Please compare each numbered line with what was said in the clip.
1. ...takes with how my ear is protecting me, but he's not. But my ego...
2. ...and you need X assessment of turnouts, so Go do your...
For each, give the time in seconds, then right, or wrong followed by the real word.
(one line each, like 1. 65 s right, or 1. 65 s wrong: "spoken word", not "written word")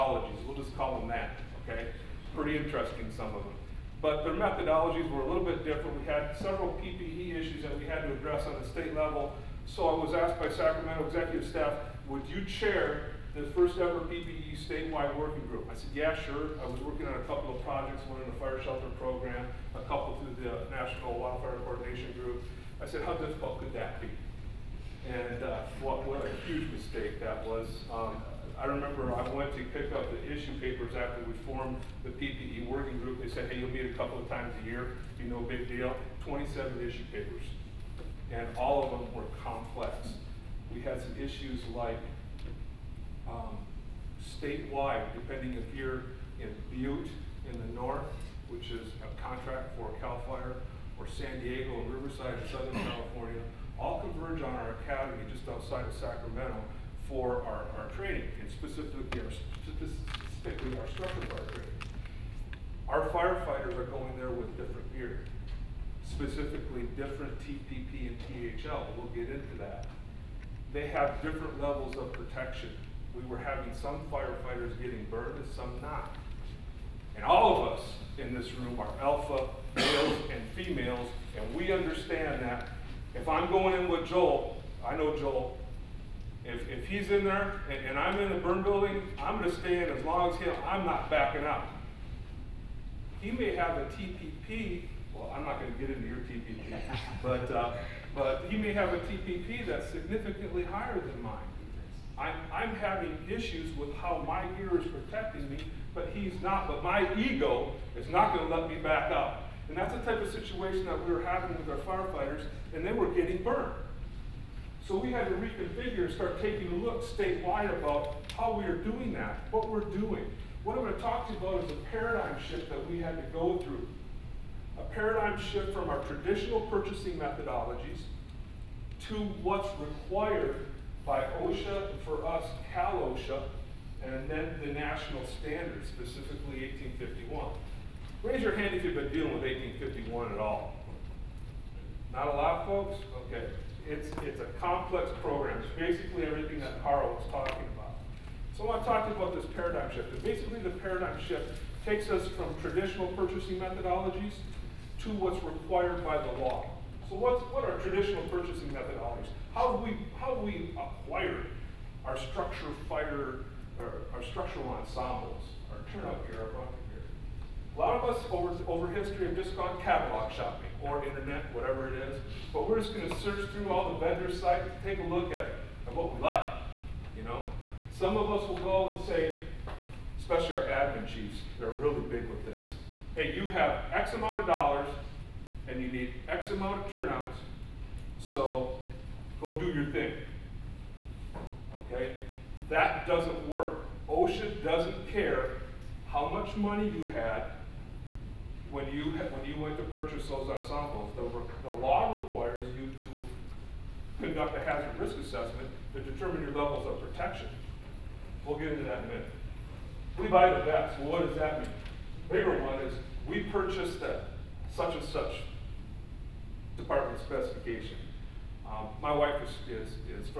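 1. 103 s wrong: "issues", not "takes"
2. 185 s wrong: "amount", not "assessment".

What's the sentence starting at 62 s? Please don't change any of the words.
Our firefighters are going there with different gear, specifically different TPP and THL.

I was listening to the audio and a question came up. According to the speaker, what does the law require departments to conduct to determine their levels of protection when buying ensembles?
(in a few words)
A hazard risk assessment.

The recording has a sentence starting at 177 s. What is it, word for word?
Some of us will go and say, especially our admin chiefs, they're really big with this.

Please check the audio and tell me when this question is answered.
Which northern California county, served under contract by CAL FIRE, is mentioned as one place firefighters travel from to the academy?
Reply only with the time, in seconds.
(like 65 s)
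46 s.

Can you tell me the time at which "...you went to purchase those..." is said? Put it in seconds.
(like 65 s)
199 s.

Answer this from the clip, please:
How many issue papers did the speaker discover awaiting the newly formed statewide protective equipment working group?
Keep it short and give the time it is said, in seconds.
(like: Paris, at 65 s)
27, at 36 s.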